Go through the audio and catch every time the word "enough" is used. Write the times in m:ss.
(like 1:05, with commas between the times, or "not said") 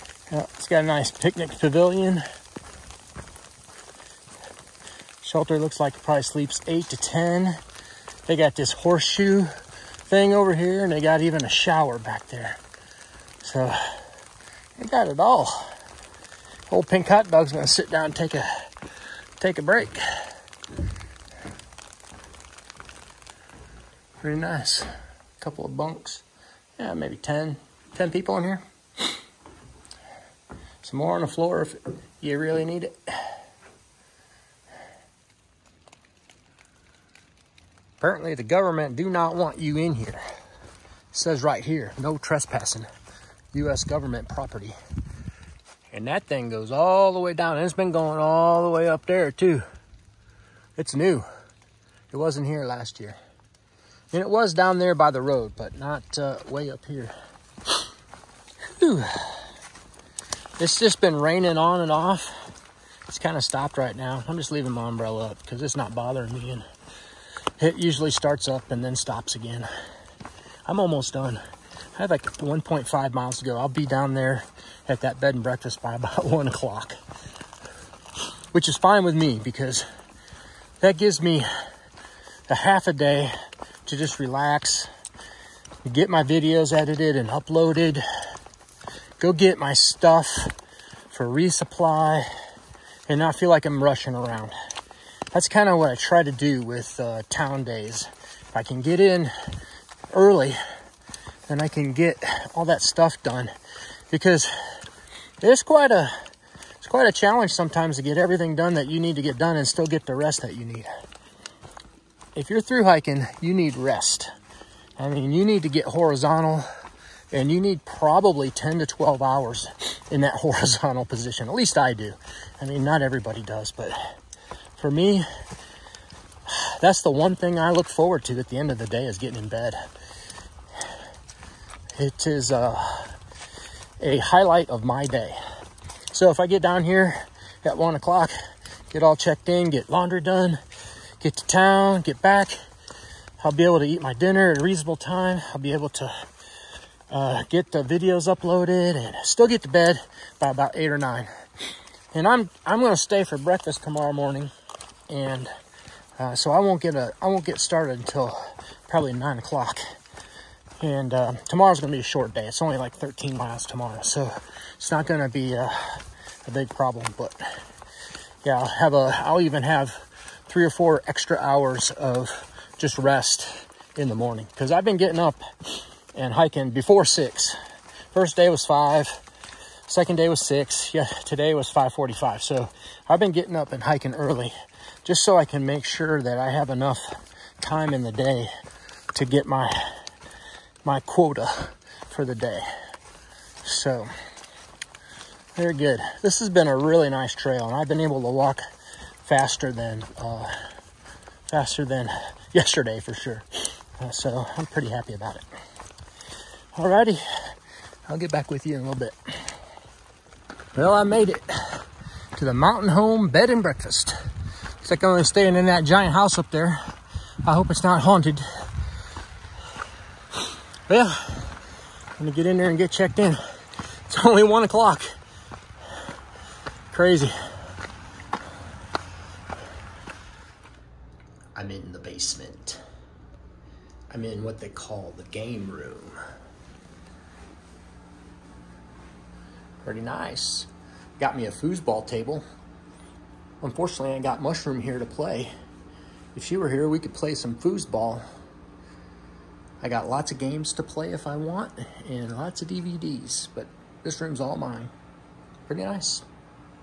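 3:06.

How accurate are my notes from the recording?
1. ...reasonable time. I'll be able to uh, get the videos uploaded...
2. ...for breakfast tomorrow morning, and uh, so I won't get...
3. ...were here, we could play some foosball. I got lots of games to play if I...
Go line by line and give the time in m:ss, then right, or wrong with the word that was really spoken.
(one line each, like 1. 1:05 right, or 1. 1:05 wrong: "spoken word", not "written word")
1. 2:24 right
2. 2:33 right
3. 4:06 right.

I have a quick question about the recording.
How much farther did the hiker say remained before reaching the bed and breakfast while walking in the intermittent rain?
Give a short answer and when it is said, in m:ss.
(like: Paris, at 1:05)
1.5 miles, at 1:12.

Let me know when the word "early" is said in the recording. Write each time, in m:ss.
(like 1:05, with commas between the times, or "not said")
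1:40, 3:04.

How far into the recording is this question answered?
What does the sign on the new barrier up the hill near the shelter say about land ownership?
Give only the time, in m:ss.
0:43.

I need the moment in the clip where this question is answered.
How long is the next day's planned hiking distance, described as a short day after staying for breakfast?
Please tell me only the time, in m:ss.
2:42.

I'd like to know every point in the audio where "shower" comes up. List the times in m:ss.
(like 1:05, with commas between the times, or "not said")
0:11.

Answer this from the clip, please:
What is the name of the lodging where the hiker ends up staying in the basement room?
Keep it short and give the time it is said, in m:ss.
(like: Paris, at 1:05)
Mountain Home Bed and Breakfast, at 3:32.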